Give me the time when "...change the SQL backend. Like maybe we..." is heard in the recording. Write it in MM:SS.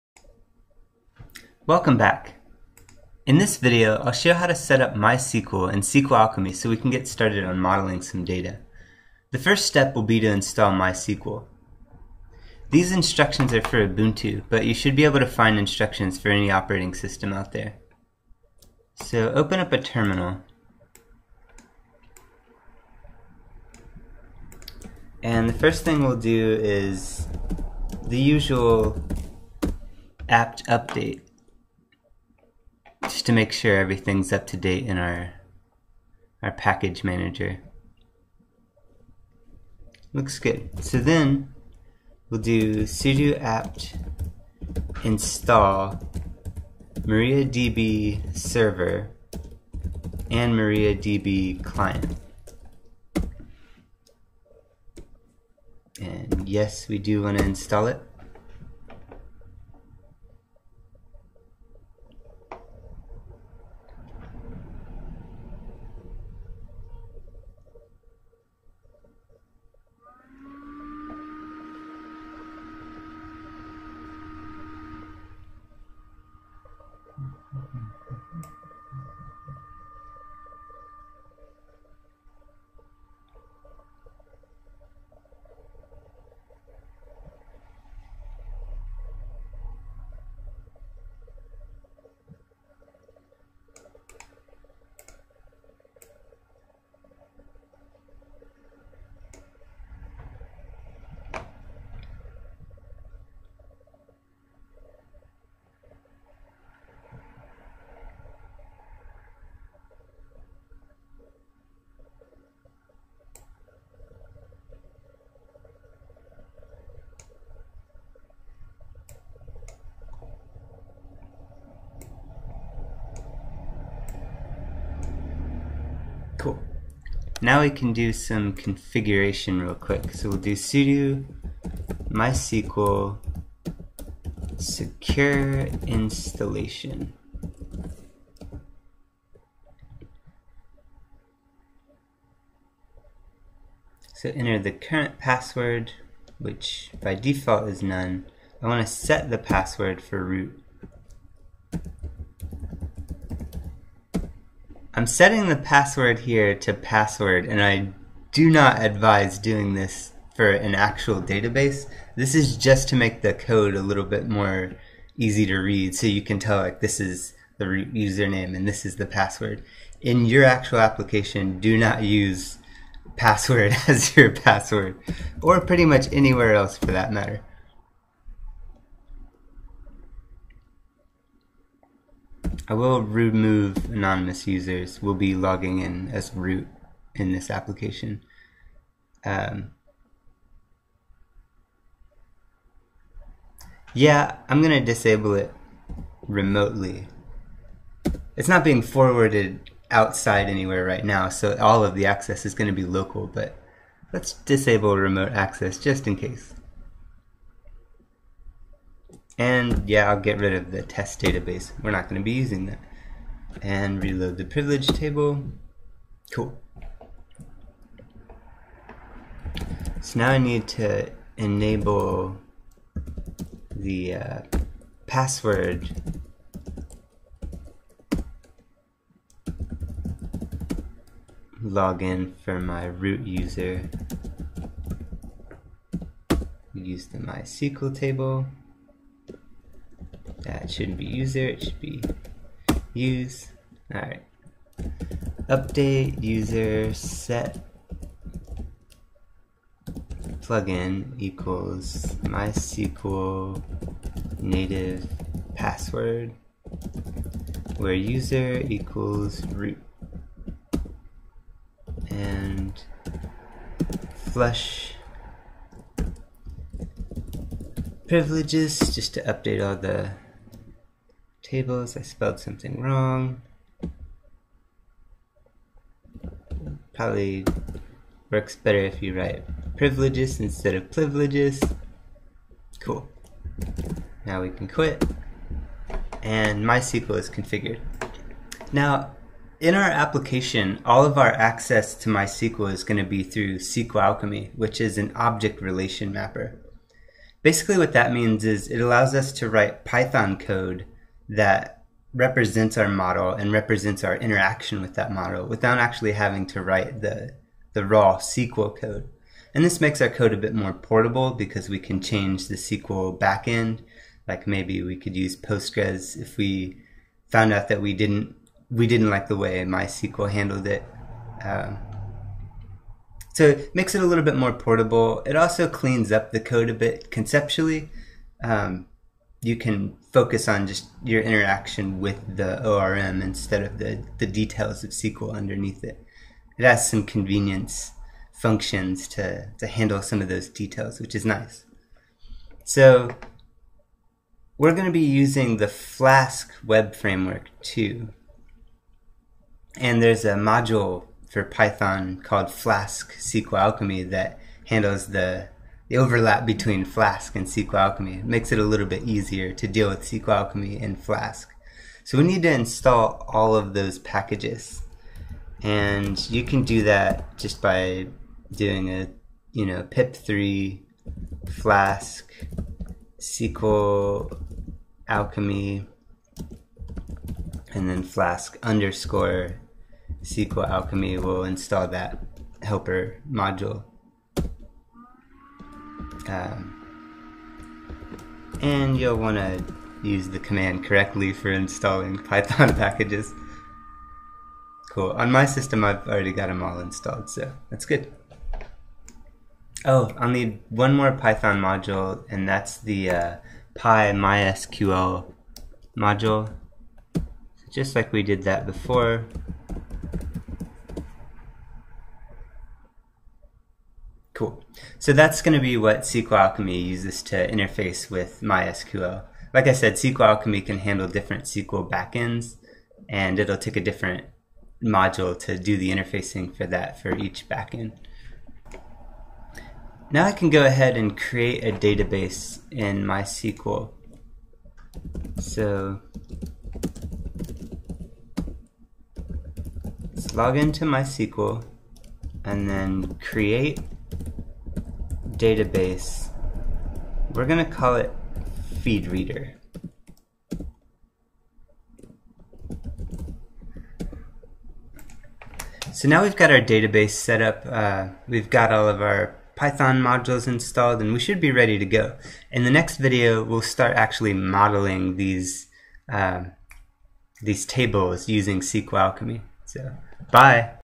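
05:12.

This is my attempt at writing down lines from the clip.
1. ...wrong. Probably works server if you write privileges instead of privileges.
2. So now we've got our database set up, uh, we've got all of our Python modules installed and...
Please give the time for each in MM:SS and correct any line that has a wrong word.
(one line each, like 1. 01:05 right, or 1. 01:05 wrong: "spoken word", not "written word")
1. 04:32 wrong: "better", not "server"
2. 07:35 right.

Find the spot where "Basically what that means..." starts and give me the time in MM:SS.
04:57.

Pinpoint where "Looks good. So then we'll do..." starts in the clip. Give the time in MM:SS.
00:40.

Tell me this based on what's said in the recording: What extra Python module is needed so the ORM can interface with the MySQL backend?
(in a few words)
PyMySQL.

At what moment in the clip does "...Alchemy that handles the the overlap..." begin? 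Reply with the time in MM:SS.
05:53.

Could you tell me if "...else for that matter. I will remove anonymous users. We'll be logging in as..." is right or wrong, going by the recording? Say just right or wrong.
right.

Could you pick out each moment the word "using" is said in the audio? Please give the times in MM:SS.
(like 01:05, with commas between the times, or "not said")
03:32, 05:44, 07:48.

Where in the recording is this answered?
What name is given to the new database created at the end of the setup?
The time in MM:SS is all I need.
07:28.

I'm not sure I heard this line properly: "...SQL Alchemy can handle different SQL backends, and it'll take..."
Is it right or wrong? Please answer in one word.
right.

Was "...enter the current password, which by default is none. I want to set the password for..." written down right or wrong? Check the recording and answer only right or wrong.
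right.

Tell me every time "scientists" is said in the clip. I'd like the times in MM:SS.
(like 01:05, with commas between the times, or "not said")
not said.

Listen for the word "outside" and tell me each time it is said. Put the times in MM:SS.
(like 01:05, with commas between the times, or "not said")
03:19.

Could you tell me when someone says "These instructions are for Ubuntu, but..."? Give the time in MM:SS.
00:12.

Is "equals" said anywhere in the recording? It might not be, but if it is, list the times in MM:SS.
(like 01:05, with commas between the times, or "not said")
04:11, 04:18.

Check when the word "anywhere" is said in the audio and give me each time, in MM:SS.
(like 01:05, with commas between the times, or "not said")
02:56, 03:20.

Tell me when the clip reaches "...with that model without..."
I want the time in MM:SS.
05:04.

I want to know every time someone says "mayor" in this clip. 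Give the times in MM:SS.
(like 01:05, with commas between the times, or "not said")
not said.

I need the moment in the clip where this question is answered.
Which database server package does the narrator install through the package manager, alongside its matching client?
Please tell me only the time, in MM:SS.
00:47.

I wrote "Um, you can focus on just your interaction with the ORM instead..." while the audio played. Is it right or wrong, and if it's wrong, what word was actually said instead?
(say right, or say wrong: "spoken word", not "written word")
right.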